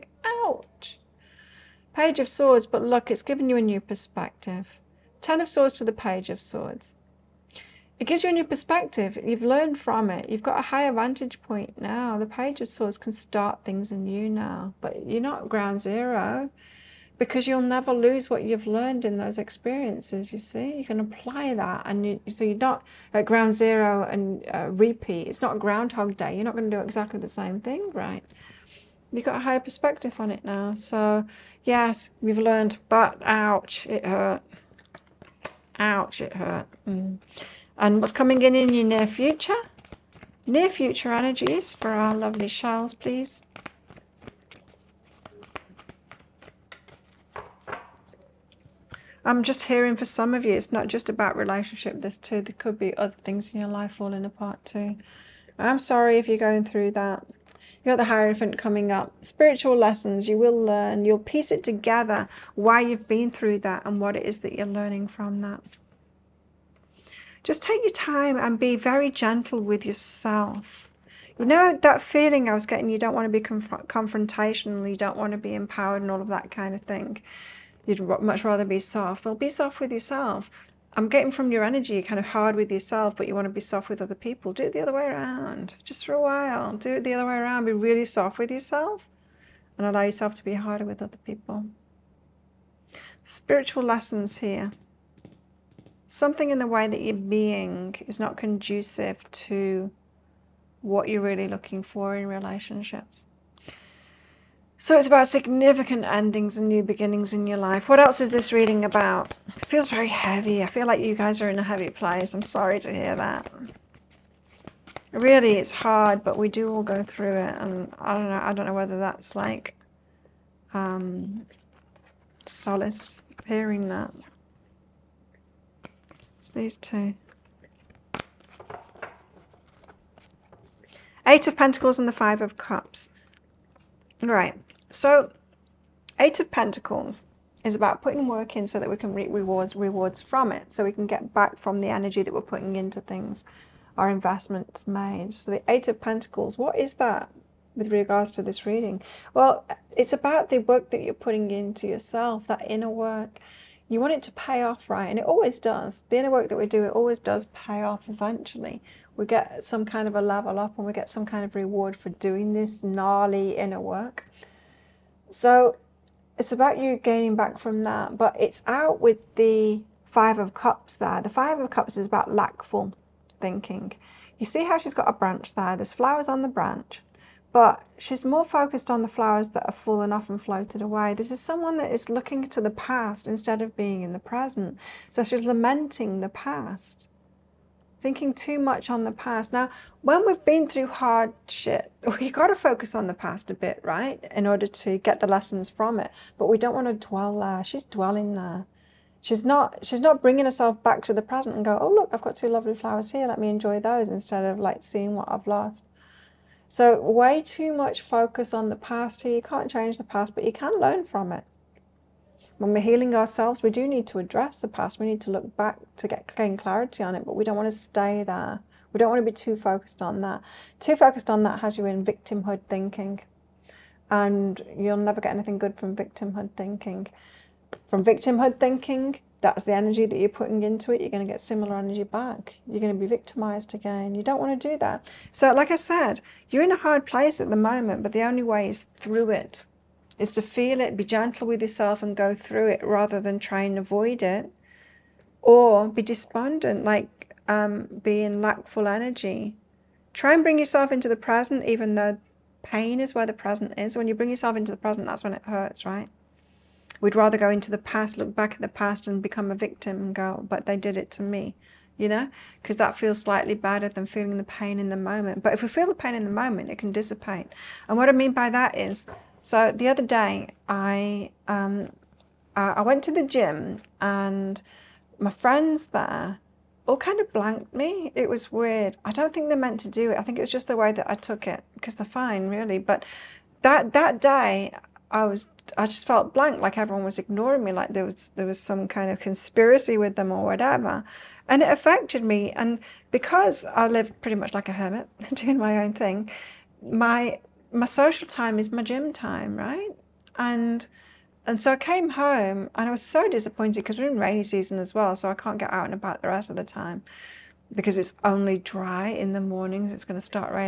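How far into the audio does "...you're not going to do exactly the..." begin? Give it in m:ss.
0:26.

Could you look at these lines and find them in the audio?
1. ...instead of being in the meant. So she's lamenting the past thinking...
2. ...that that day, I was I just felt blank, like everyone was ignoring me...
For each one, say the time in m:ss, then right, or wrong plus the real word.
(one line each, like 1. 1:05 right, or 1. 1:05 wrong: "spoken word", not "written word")
1. 3:03 wrong: "present", not "meant"
2. 4:43 right.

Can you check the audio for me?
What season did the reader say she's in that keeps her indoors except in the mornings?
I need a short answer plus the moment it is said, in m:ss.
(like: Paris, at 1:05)
Rainy season, at 5:04.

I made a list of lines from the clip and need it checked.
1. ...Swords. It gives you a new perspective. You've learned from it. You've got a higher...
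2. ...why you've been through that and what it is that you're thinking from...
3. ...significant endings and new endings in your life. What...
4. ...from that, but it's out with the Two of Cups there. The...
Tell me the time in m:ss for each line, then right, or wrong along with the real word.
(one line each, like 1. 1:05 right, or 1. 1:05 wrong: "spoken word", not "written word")
1. 0:06 right
2. 1:02 wrong: "learning", not "thinking"
3. 1:45 wrong: "beginnings", not "endings"
4. 2:47 wrong: "Five", not "Two".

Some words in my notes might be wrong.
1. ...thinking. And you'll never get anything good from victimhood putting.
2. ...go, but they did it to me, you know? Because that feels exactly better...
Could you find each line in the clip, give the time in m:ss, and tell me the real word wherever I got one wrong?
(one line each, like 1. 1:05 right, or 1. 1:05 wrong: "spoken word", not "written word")
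1. 3:42 wrong: "thinking", not "putting"
2. 4:20 wrong: "slightly", not "exactly".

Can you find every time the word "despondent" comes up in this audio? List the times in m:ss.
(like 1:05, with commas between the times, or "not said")
4:06.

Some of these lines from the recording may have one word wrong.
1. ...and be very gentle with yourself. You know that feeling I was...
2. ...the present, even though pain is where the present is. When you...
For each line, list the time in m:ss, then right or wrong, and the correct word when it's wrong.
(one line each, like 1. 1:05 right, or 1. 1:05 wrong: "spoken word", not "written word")
1. 1:08 right
2. 4:11 right.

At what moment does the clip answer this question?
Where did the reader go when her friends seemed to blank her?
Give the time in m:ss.
4:33.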